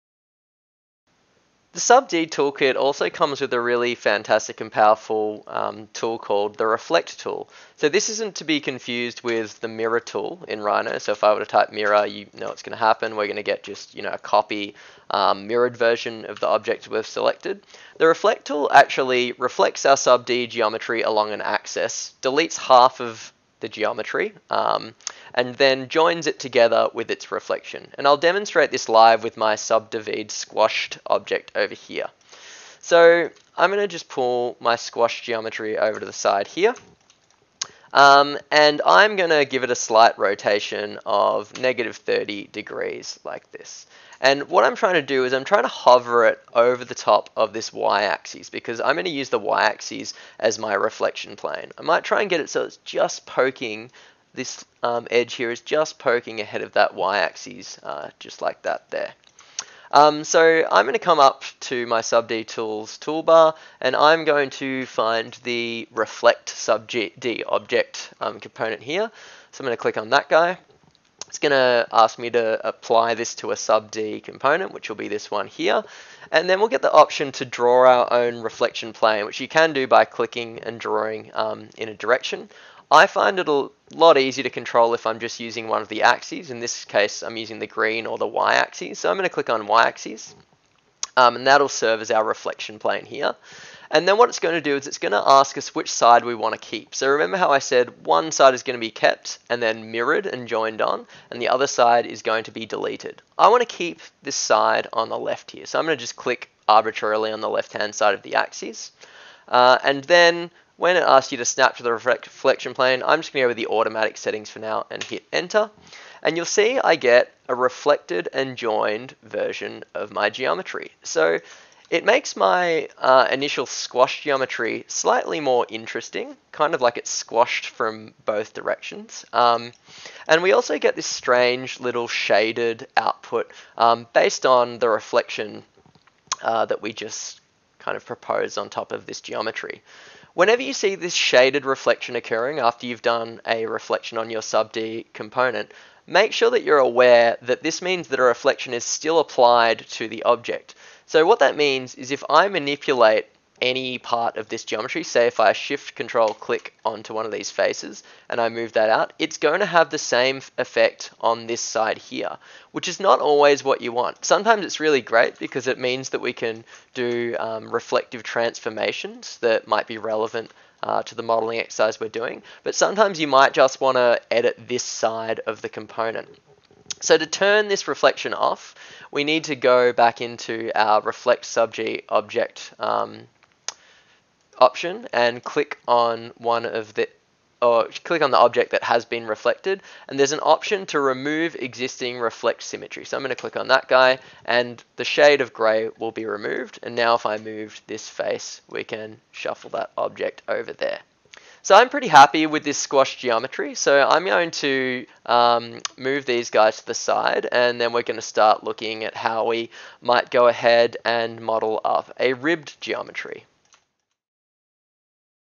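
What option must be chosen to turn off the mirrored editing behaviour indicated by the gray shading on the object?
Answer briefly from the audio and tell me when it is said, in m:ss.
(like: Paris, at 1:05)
Remove existing reflect symmetry, at 3:10.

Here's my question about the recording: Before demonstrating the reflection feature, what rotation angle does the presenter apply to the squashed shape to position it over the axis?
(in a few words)
-30 degrees.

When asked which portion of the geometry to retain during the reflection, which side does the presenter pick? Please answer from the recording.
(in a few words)
Left.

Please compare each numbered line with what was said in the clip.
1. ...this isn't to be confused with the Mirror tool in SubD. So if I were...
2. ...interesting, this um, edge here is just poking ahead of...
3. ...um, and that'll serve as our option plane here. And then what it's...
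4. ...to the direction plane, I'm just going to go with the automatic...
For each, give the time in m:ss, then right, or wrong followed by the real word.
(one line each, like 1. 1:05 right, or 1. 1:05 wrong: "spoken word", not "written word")
1. 0:07 wrong: "Rhino", not "SubD"
2. 0:53 wrong: "poking", not "interesting"
3. 1:31 wrong: "reflection", not "option"
4. 1:51 wrong: "reflection", not "direction".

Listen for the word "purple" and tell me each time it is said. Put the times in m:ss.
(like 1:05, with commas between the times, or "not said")
not said.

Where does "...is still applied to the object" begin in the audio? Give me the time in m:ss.
2:28.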